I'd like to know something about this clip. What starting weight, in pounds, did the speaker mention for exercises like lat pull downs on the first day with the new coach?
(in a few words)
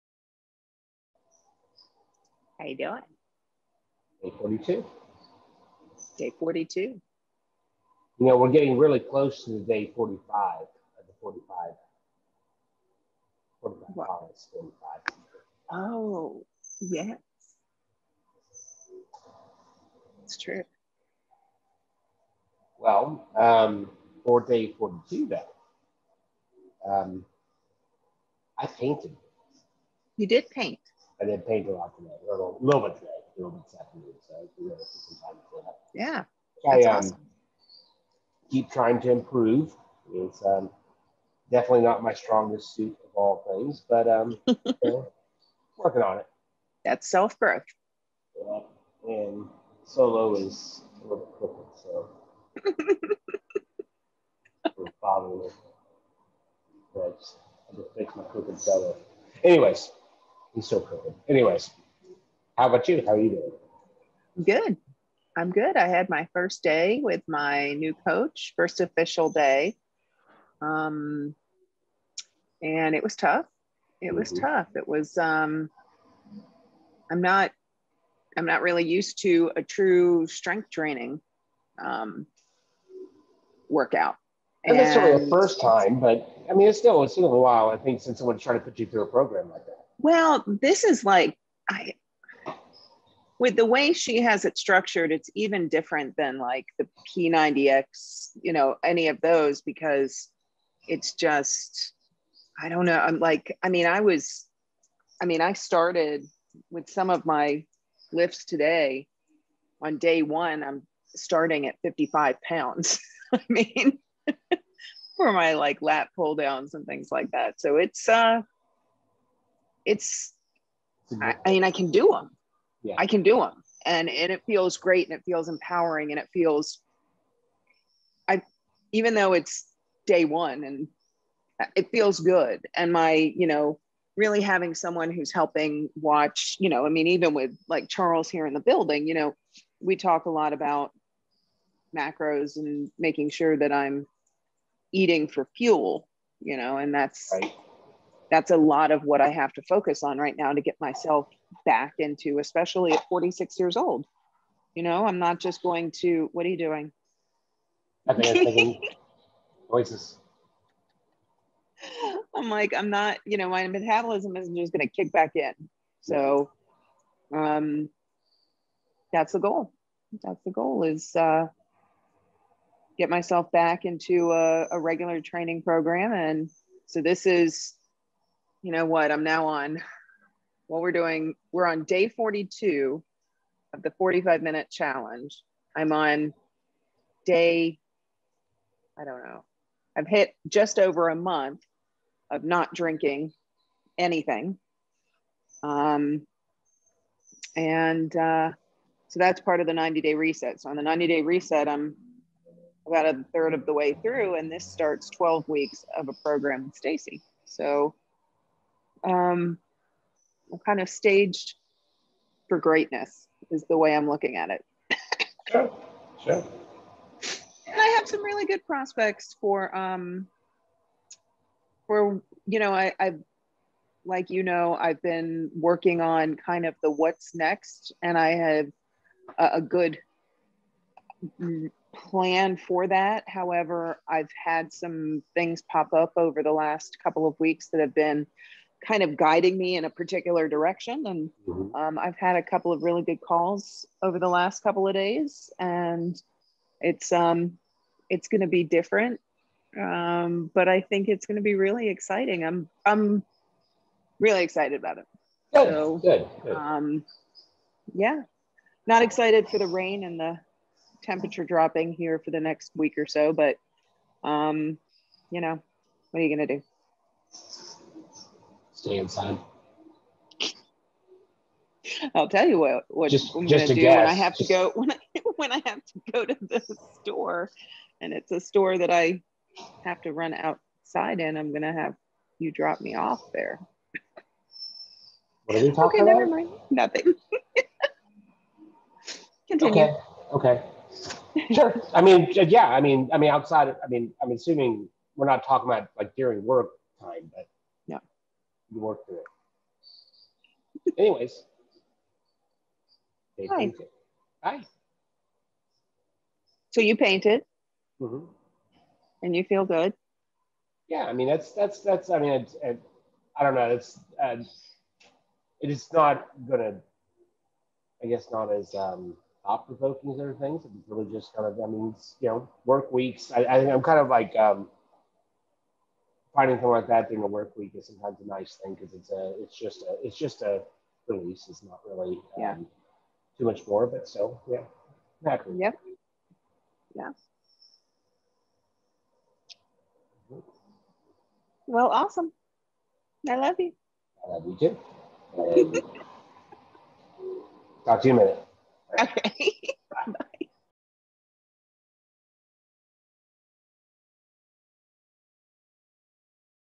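55 pounds.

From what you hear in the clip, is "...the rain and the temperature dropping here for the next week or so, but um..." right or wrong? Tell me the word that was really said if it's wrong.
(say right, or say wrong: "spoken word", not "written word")
right.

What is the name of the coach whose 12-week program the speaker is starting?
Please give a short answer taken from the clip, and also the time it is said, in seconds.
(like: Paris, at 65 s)
Stacy, at 206 s.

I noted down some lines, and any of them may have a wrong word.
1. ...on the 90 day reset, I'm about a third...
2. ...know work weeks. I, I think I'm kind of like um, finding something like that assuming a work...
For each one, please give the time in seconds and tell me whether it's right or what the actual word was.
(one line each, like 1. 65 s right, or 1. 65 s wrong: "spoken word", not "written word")
1. 200 s right
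2. 322 s wrong: "during", not "assuming".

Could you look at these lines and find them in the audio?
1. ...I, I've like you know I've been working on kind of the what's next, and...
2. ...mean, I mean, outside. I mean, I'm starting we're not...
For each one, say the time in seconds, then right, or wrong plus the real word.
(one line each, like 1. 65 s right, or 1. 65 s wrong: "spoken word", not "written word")
1. 222 s right
2. 292 s wrong: "assuming", not "starting".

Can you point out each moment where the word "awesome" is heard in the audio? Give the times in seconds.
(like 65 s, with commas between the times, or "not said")
36 s, 341 s.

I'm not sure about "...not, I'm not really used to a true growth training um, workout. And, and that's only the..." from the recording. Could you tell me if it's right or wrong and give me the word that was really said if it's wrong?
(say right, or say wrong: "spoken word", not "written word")
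wrong: "strength", not "growth".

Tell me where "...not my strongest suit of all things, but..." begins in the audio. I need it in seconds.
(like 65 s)
41 s.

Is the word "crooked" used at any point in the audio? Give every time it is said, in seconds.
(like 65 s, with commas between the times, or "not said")
51 s, 58 s.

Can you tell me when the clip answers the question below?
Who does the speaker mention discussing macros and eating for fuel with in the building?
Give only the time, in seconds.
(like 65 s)
137 s.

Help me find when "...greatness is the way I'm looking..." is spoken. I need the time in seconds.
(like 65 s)
212 s.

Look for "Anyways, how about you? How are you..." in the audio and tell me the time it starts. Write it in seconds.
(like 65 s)
61 s.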